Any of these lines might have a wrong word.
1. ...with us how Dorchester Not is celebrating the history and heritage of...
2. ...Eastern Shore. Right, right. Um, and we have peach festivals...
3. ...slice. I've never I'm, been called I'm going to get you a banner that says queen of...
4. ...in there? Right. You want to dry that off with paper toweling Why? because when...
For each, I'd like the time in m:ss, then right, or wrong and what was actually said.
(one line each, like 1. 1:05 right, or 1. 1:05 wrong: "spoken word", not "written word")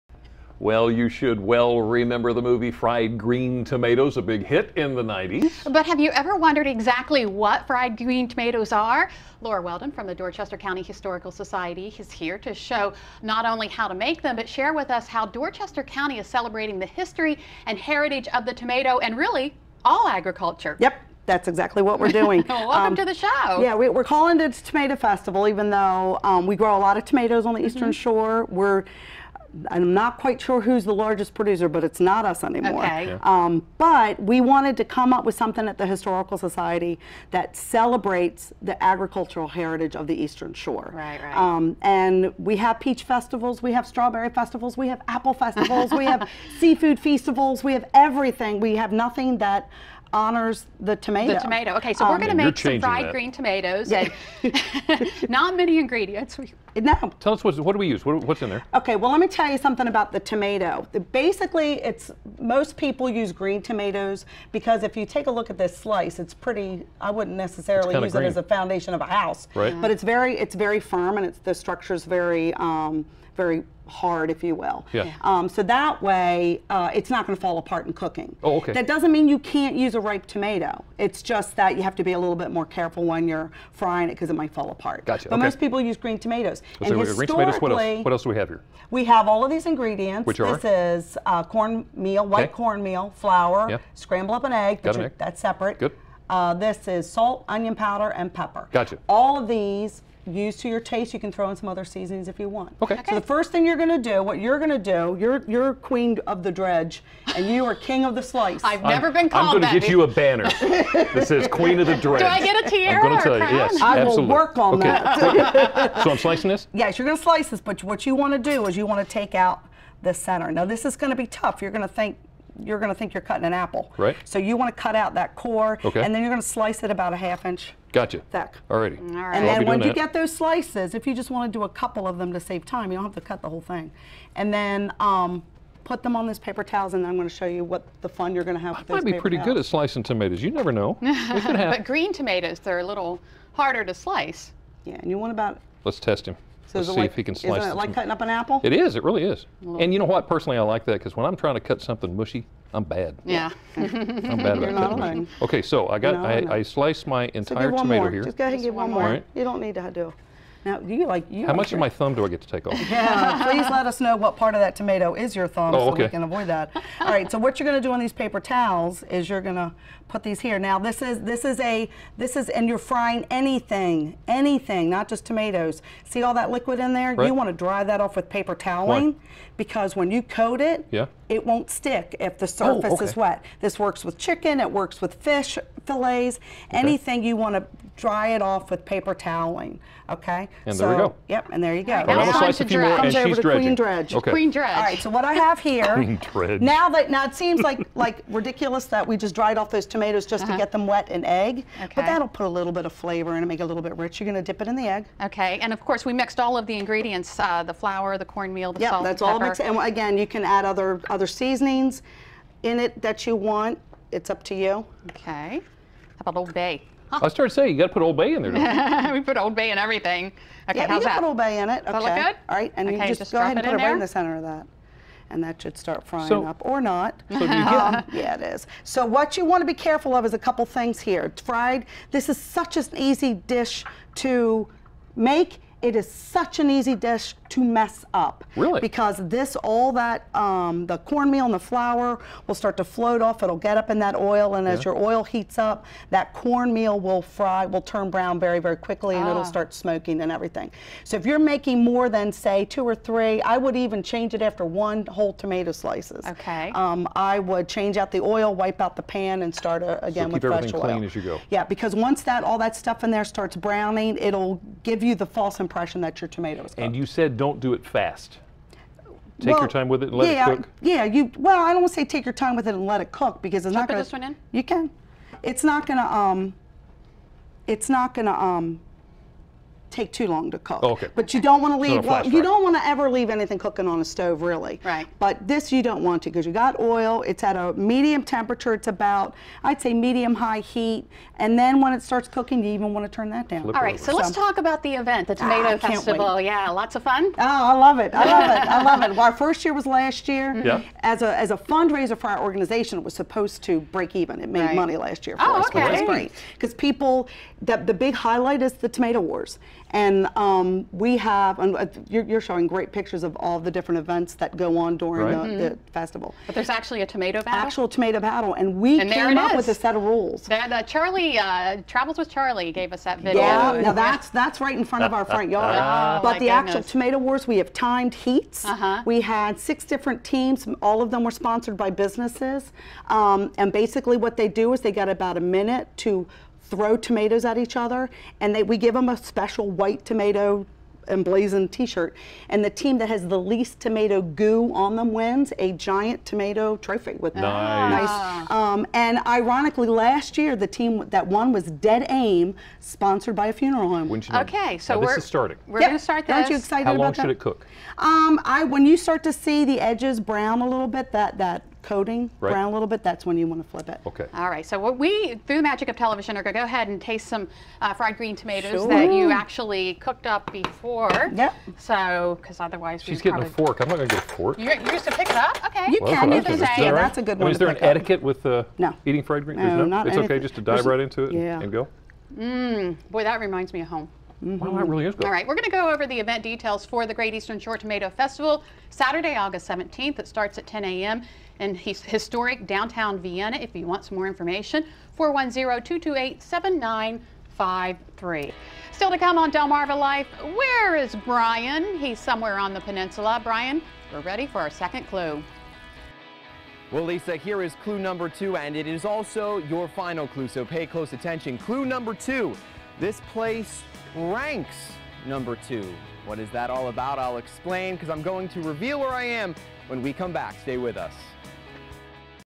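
1. 0:14 wrong: "County", not "Not"
2. 0:40 right
3. 1:48 right
4. 2:56 right.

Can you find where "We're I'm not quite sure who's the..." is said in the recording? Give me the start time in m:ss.
0:28.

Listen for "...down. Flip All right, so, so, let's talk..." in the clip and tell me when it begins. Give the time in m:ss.
4:53.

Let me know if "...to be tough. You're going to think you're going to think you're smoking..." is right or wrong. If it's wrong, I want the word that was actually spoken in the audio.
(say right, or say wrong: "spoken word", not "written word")
wrong: "cutting", not "smoking".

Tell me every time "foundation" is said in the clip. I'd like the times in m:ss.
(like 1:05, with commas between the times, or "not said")
1:08.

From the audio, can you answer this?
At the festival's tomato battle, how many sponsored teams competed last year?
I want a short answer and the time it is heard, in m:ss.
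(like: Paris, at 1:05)
6, at 5:29.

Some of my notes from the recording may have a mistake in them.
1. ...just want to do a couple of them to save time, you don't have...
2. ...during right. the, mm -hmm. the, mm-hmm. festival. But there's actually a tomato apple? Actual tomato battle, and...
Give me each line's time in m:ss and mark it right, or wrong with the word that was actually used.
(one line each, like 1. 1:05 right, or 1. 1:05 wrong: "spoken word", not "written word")
1. 2:11 right
2. 5:14 wrong: "battle", not "apple".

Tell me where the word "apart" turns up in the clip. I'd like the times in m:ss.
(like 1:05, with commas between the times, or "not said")
1:17, 1:24.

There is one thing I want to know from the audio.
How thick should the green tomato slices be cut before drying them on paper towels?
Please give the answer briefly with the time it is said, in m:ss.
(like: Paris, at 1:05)
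half inch, at 2:07.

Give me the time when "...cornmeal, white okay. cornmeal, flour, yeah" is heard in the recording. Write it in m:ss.
1:31.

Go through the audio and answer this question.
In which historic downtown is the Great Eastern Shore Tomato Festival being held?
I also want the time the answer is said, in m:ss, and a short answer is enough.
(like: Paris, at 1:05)
Vienna, at 6:33.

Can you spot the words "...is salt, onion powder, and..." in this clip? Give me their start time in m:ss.
1:36.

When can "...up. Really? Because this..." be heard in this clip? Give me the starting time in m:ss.
3:58.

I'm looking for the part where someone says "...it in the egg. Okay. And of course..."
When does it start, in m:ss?
3:24.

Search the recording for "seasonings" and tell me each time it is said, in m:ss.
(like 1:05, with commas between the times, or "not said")
1:41, 3:31.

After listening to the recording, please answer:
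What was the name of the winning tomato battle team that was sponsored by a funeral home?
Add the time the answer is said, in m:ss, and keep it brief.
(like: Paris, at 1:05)
Dead Aim, at 5:51.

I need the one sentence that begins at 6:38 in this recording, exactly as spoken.
Still to come on Delmarva Life, where is Brian?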